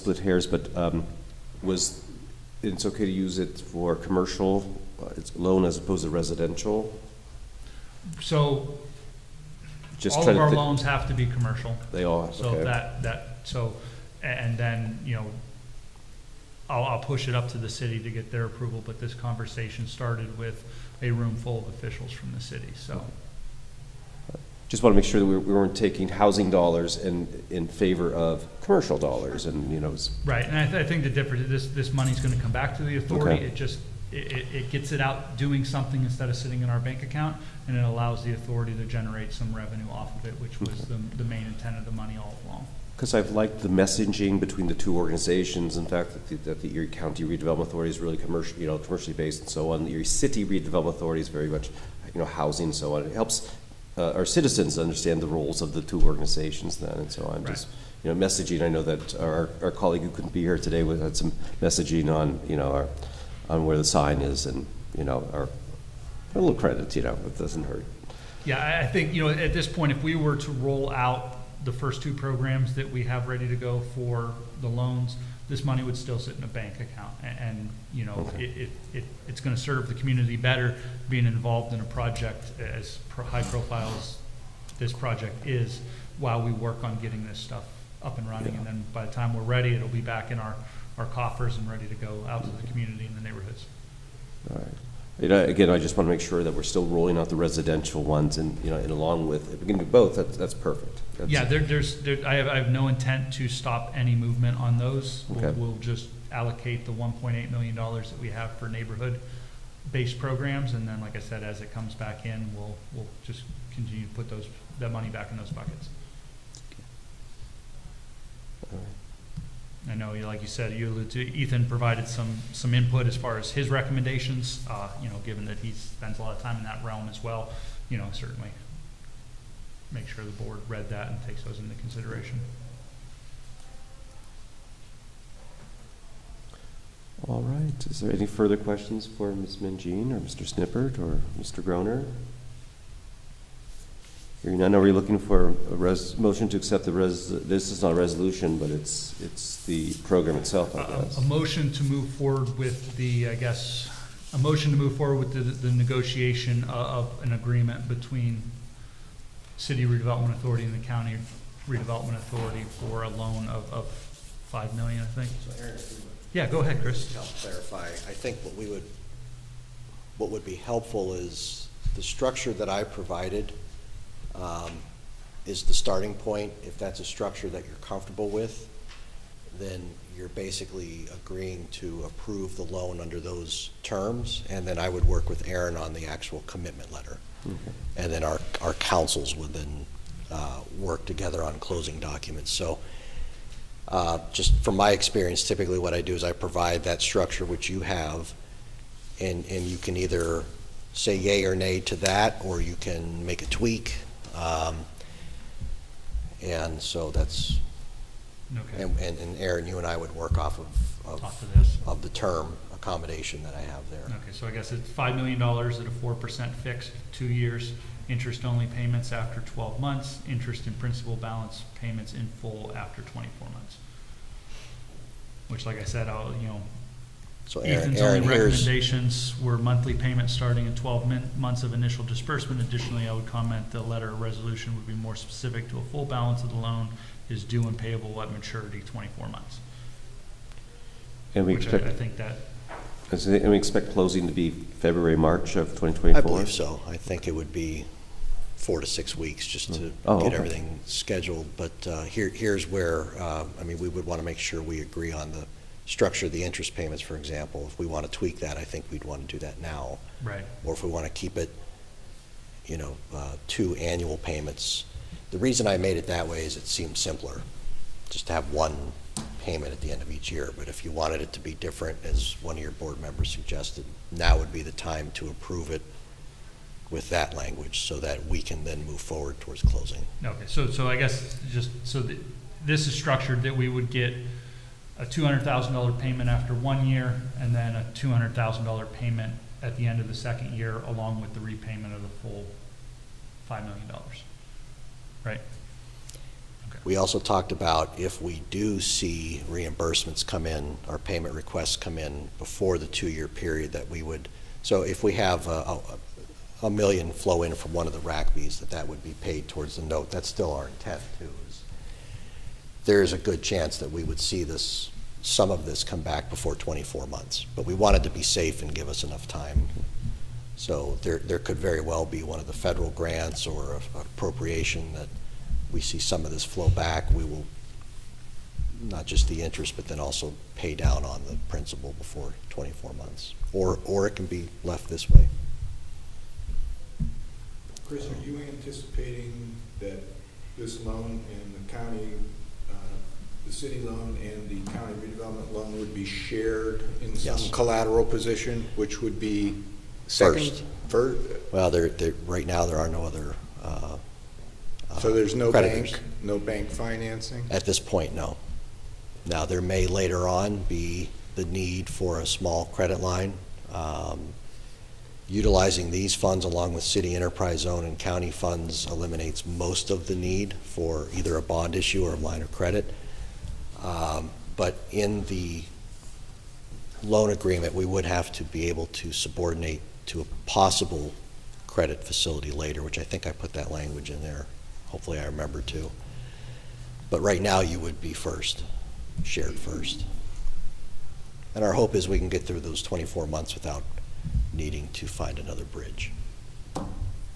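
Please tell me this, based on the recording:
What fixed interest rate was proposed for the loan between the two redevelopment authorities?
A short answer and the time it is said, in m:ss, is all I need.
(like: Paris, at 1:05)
4%, at 3:35.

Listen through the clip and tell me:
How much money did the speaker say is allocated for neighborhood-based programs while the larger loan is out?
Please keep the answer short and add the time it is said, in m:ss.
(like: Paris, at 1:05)
$1.8 million, at 1:46.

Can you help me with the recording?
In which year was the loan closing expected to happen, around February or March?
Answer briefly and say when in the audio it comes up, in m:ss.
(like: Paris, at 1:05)
2024, at 4:05.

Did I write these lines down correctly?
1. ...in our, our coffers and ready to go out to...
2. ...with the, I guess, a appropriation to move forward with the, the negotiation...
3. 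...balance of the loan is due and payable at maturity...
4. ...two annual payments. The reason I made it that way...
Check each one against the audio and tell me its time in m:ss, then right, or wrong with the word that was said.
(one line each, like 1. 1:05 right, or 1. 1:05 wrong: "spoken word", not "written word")
1. 1:30 right
2. 2:32 wrong: "motion", not "appropriation"
3. 3:56 right
4. 4:23 right.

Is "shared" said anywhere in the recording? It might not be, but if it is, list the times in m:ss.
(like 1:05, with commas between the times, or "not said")
5:46, 6:29.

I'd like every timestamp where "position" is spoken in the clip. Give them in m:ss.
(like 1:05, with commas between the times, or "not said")
5:48.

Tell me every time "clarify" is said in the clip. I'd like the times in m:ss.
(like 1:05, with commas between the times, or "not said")
2:47.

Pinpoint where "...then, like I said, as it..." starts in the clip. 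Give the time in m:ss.
1:50.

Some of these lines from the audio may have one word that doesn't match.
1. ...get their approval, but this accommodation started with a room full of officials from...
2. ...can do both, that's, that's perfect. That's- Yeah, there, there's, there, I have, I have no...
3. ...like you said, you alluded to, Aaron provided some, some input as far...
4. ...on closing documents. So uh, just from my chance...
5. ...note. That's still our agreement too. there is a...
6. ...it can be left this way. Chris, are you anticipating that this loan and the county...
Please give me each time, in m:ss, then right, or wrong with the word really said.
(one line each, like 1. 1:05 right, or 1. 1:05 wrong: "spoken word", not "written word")
1. 0:18 wrong: "conversation", not "accommodation"
2. 1:39 right
3. 2:00 wrong: "Ethan", not "Aaron"
4. 3:11 wrong: "experience", not "chance"
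5. 5:09 wrong: "intent", not "agreement"
6. 5:34 right.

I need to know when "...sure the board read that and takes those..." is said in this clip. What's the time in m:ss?
2:10.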